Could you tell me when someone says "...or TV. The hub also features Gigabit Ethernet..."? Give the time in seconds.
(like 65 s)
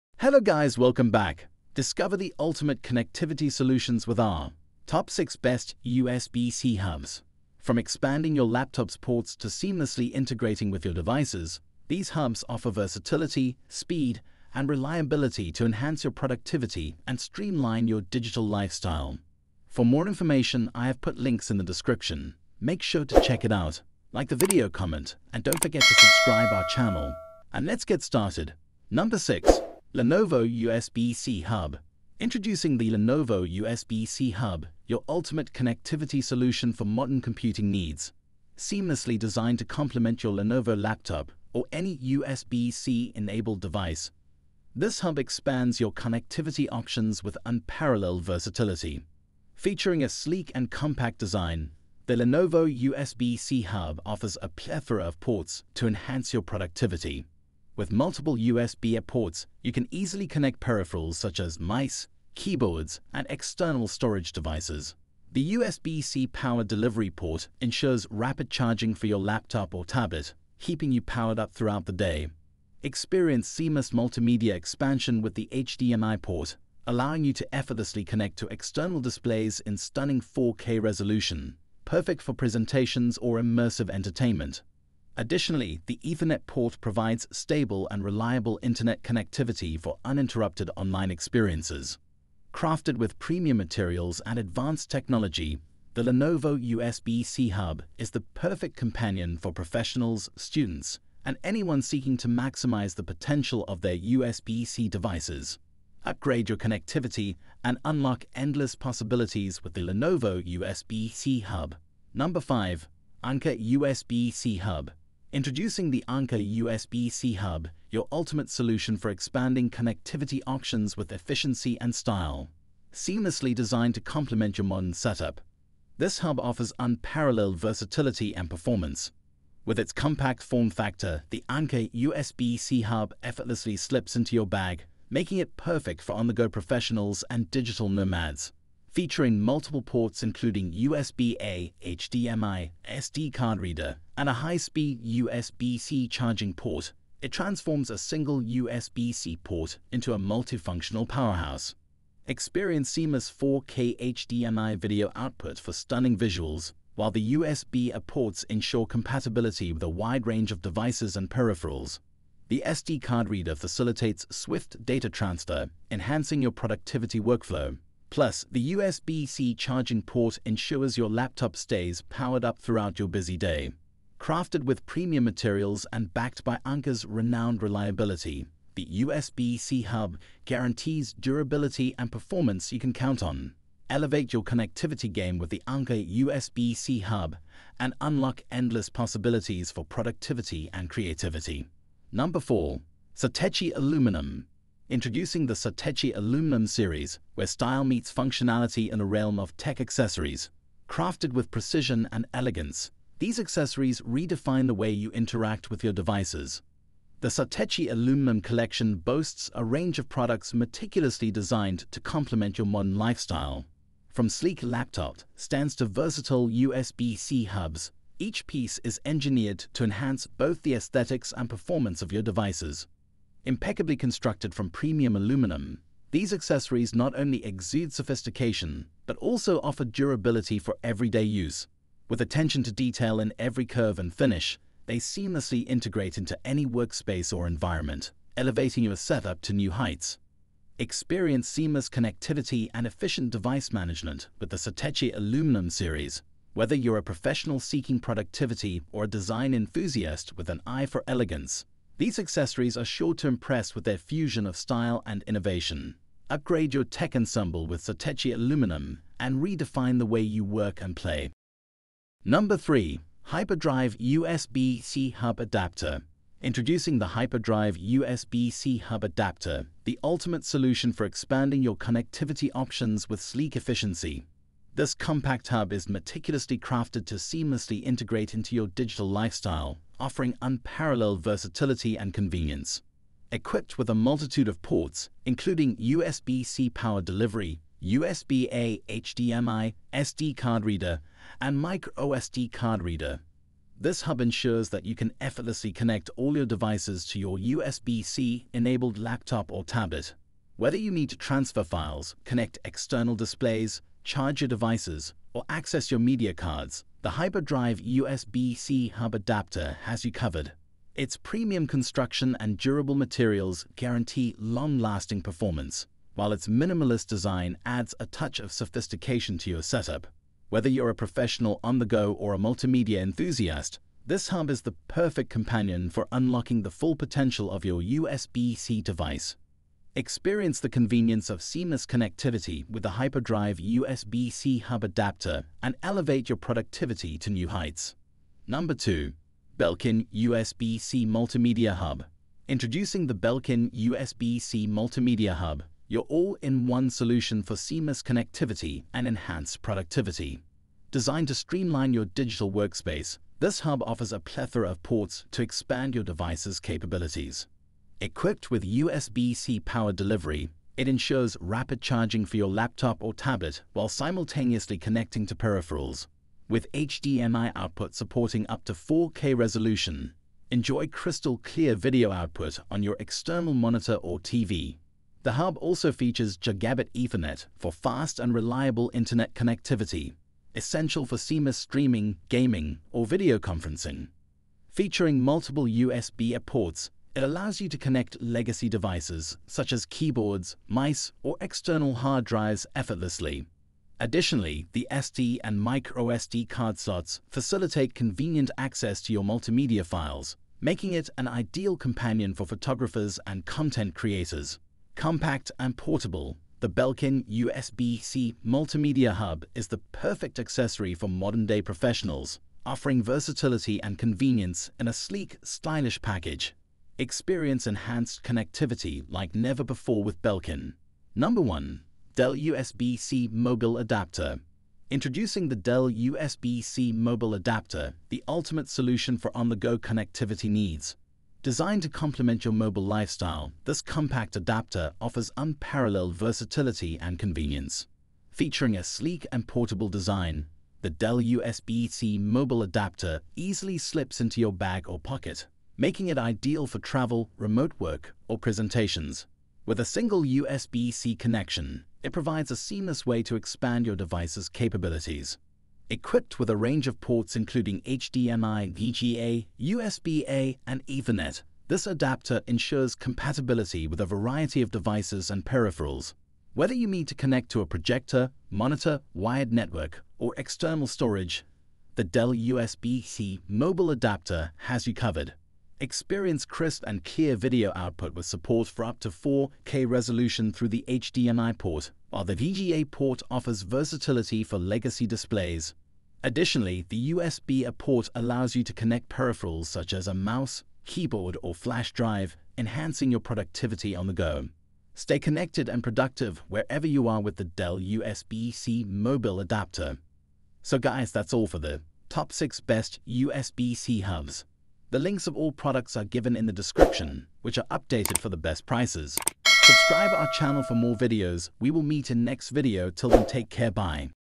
373 s.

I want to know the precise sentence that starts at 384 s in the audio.
Featuring multiple USB ports it allows you to connect legacy devices, such as keyboards, mice, or external hard drives effortlessly.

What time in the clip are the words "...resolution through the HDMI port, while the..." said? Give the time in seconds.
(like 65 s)
479 s.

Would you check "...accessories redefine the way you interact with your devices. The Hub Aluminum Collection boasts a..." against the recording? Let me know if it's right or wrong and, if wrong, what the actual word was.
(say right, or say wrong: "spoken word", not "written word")
wrong: "Satechi", not "Hub".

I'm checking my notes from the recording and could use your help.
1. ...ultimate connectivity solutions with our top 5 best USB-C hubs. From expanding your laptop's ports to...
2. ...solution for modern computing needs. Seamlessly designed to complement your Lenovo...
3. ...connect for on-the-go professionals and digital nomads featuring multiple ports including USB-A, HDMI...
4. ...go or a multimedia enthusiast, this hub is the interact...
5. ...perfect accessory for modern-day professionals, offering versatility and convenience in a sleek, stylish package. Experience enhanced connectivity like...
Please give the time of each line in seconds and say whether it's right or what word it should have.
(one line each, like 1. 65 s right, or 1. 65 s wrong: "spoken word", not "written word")
1. 2 s wrong: "6", not "5"
2. 36 s right
3. 135 s wrong: "perfect", not "connect"
4. 321 s wrong: "perfect", not "interact"
5. 409 s right.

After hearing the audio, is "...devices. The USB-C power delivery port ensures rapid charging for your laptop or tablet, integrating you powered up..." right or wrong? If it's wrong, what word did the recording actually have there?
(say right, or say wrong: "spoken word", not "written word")
wrong: "keeping", not "integrating".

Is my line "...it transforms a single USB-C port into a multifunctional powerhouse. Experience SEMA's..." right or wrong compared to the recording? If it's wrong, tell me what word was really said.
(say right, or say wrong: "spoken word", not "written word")
right.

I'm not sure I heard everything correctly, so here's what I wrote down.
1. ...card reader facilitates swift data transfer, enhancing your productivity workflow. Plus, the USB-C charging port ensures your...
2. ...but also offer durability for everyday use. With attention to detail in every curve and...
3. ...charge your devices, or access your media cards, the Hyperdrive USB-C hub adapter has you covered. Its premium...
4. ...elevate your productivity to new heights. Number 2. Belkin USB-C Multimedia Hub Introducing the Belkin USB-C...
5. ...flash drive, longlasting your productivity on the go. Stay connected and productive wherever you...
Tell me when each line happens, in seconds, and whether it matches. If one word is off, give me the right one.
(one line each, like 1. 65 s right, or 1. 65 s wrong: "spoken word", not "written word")
1. 163 s right
2. 229 s right
3. 304 s right
4. 335 s right
5. 491 s wrong: "enhancing", not "longlasting".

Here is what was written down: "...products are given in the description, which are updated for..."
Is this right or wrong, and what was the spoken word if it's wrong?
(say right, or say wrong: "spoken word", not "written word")
right.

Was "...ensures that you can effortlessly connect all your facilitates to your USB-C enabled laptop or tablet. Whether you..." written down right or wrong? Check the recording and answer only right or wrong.
wrong.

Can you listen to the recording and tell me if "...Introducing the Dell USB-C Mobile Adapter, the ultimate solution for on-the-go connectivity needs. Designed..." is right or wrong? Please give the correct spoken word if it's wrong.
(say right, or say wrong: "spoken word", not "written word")
right.